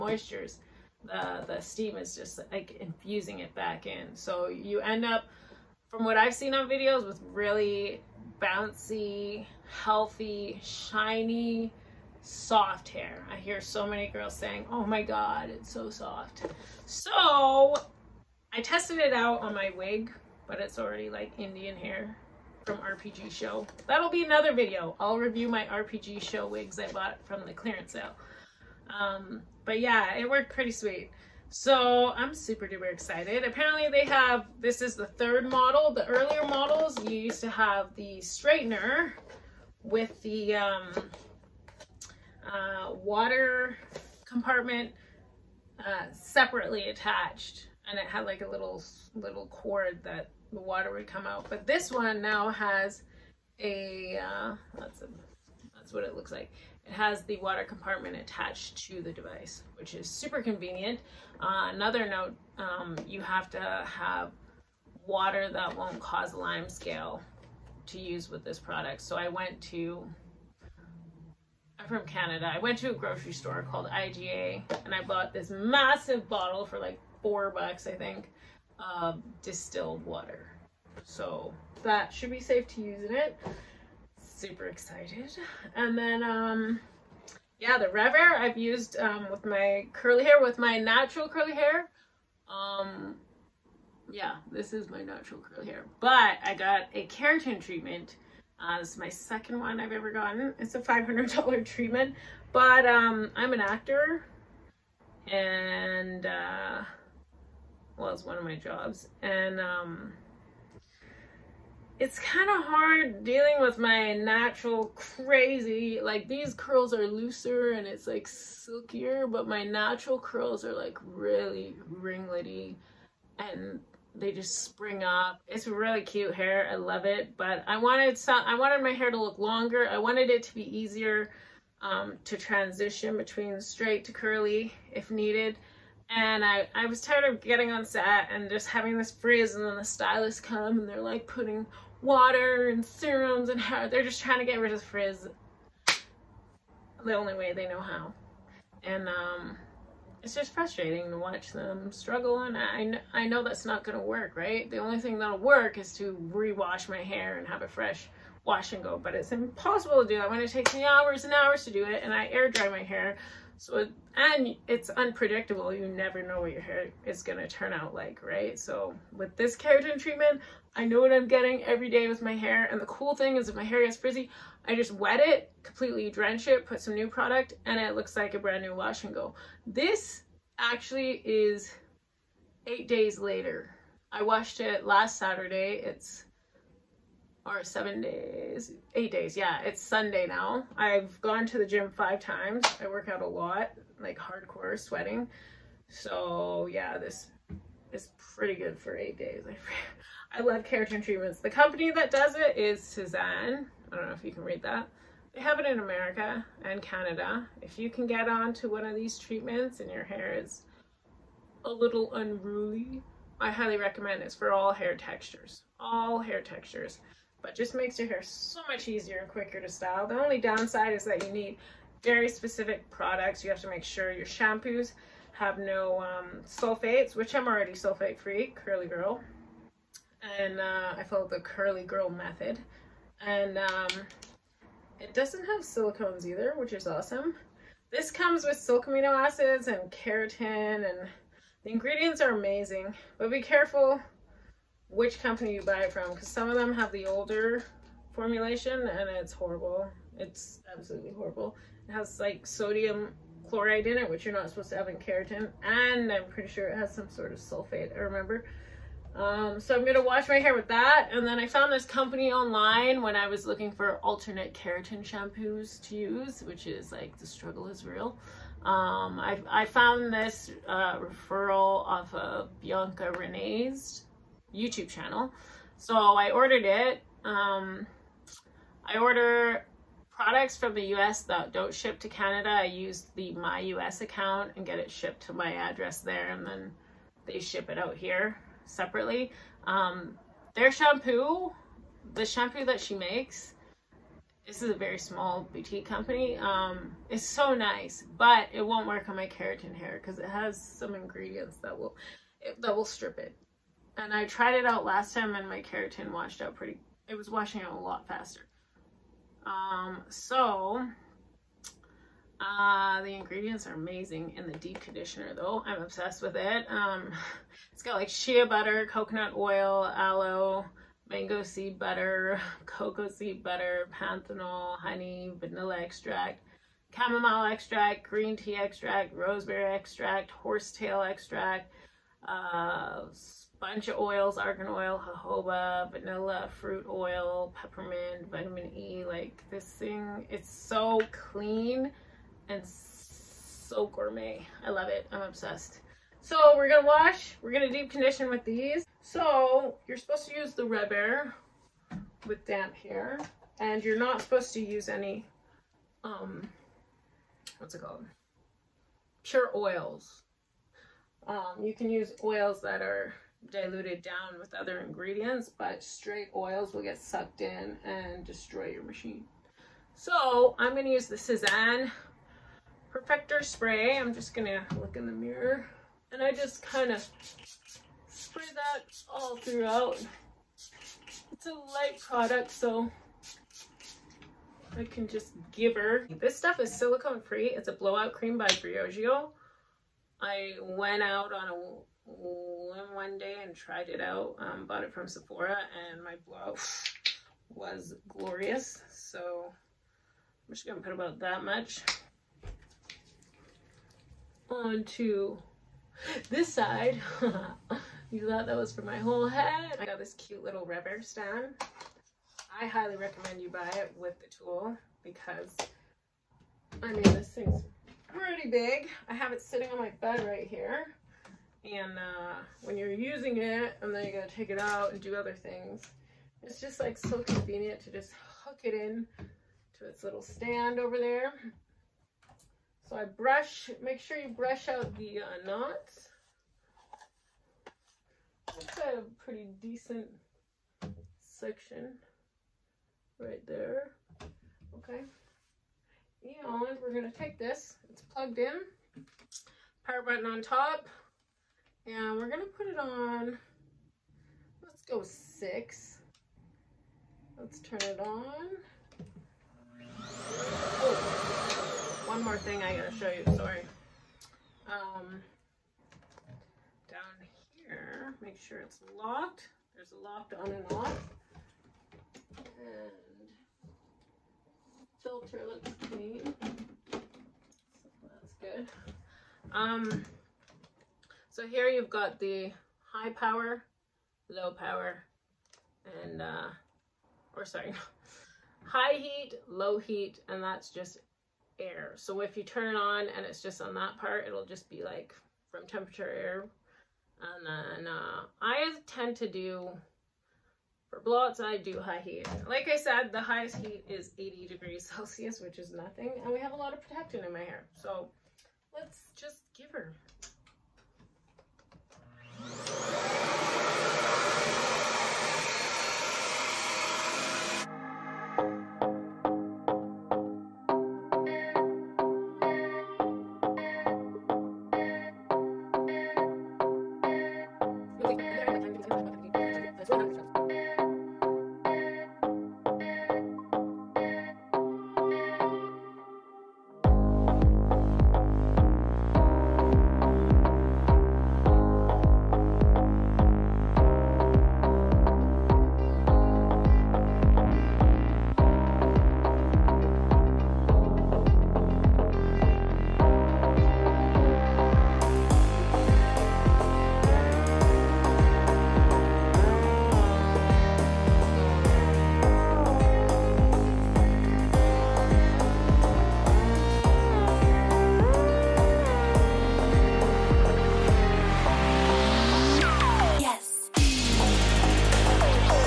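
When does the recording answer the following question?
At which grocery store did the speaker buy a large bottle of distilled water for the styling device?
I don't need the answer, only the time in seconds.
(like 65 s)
73 s.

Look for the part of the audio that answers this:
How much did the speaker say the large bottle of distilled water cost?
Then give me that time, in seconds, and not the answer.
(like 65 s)
77 s.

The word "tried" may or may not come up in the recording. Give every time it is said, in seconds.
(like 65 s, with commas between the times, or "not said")
304 s, 393 s.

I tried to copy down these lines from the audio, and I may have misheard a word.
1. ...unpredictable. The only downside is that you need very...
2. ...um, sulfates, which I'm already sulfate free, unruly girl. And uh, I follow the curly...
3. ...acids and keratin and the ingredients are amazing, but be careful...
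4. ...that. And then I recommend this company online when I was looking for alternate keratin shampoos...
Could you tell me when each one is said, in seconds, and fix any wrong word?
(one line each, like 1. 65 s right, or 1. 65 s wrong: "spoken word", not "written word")
1. 219 s wrong: "style", not "unpredictable"
2. 226 s wrong: "curly", not "unruly"
3. 239 s right
4. 260 s wrong: "found", not "recommend".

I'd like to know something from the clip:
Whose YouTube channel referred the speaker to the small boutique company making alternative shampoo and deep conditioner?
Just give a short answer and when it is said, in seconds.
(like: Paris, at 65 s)
Bianca Renee, at 272 s.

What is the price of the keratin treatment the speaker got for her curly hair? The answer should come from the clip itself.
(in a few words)
$500.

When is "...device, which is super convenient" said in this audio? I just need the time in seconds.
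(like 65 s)
59 s.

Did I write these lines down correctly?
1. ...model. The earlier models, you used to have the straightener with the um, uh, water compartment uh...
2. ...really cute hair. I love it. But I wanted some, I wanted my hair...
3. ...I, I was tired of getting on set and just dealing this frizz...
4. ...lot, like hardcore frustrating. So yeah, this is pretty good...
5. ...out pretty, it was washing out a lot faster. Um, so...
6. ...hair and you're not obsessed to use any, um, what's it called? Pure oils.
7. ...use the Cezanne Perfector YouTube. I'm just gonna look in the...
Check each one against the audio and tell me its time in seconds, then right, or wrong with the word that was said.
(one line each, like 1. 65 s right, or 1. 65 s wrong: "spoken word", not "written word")
1. 35 s right
2. 125 s right
3. 136 s wrong: "having", not "dealing"
4. 193 s wrong: "sweating", not "frustrating"
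5. 306 s right
6. 352 s wrong: "supposed", not "obsessed"
7. 370 s wrong: "Spray", not "YouTube".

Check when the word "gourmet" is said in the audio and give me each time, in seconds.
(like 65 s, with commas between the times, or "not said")
343 s.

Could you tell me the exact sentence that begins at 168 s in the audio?
So with this keratin treatment, I know what I'm getting every day with my hair.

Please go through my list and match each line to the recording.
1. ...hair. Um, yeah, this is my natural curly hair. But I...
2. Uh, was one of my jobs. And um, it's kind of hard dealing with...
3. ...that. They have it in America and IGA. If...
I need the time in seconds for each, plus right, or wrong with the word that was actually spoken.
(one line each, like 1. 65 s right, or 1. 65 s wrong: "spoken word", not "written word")
1. 91 s right
2. 106 s right
3. 204 s wrong: "Canada", not "IGA".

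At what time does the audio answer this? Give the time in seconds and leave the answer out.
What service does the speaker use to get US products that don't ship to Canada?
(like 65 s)
283 s.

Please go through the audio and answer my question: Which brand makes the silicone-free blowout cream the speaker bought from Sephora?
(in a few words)
Briogeo.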